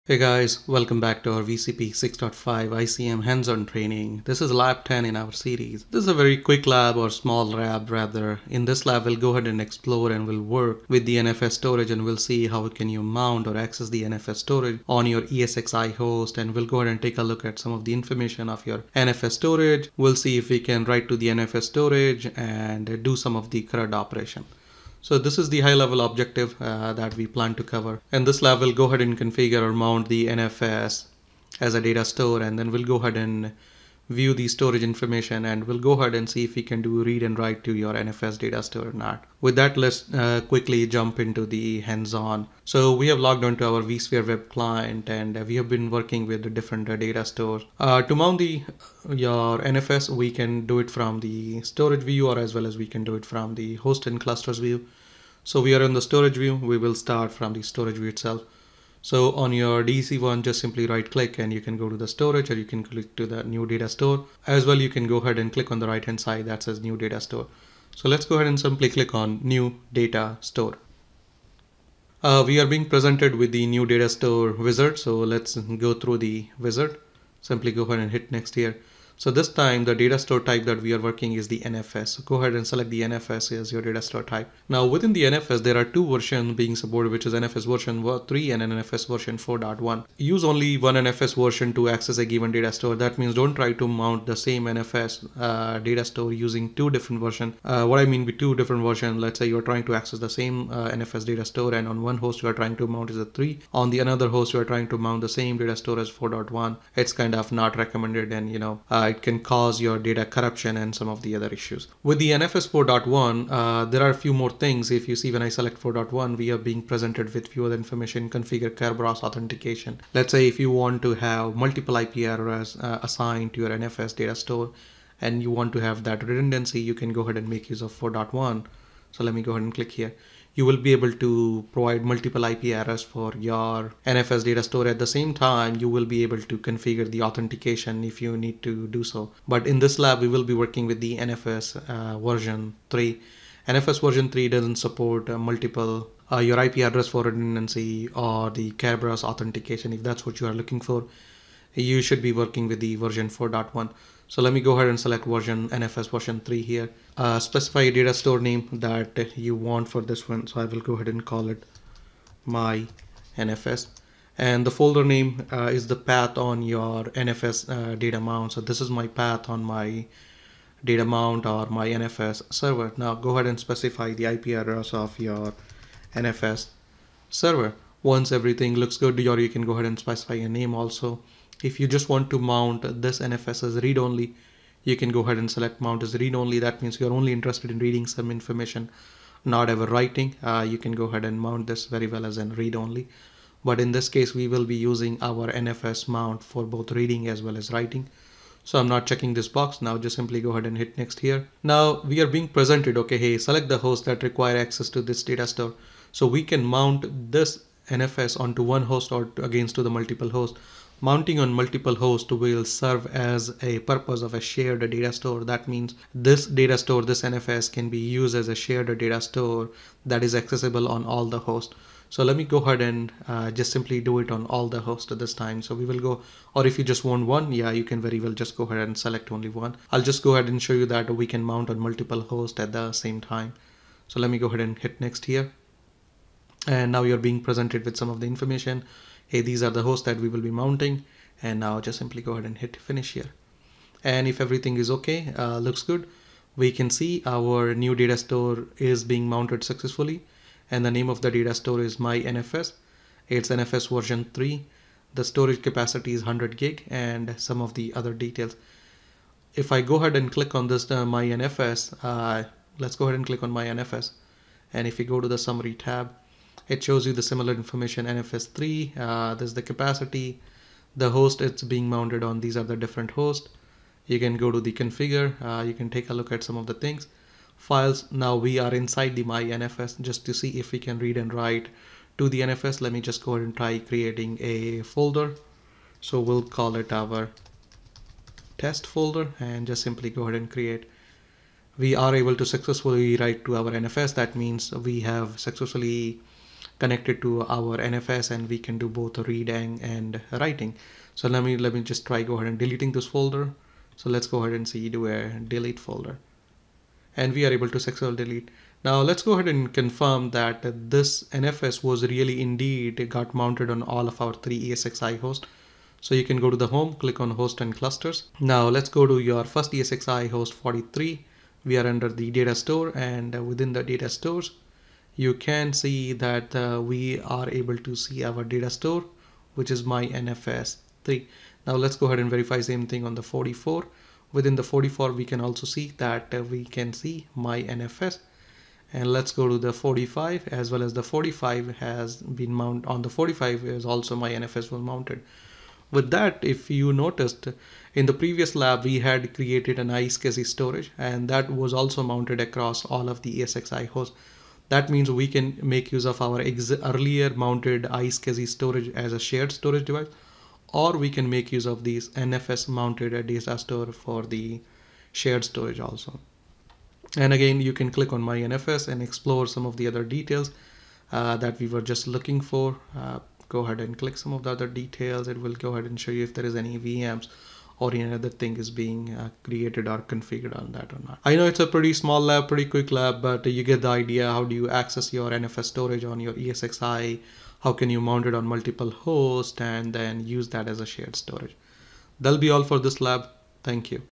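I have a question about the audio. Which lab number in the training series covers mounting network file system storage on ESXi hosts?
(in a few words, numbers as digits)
10.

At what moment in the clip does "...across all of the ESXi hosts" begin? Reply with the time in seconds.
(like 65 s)
352 s.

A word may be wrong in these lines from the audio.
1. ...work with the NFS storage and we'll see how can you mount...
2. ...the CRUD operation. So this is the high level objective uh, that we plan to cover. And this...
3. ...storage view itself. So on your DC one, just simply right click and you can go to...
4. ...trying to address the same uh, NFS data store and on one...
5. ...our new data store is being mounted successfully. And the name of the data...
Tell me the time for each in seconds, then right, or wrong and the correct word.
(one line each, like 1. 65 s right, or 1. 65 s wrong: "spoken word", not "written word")
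1. 10 s right
2. 23 s right
3. 57 s right
4. 99 s wrong: "access", not "address"
5. 247 s right.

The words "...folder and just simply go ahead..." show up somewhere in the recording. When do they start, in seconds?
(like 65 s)
288 s.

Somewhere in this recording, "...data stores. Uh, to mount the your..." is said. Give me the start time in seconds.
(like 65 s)
46 s.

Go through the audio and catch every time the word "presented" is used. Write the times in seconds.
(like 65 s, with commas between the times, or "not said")
72 s, 116 s, 202 s, 237 s.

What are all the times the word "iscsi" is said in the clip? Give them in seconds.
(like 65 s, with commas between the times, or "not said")
350 s, 357 s.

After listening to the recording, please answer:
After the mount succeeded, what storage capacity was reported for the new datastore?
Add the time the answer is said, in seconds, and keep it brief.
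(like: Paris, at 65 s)
100 gig, at 256 s.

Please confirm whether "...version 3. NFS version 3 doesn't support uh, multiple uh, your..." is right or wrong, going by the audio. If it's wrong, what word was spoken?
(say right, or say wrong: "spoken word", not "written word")
right.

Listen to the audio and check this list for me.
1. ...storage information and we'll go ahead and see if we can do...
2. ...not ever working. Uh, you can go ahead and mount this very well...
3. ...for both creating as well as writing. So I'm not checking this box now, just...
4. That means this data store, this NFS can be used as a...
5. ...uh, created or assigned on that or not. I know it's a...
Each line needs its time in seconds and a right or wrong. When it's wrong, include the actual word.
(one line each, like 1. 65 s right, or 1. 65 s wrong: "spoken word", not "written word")
1. 34 s right
2. 189 s wrong: "writing", not "working"
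3. 196 s wrong: "reading", not "creating"
4. 215 s right
5. 379 s wrong: "configured", not "assigned".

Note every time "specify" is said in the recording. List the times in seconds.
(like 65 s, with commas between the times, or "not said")
157 s, 173 s, 179 s.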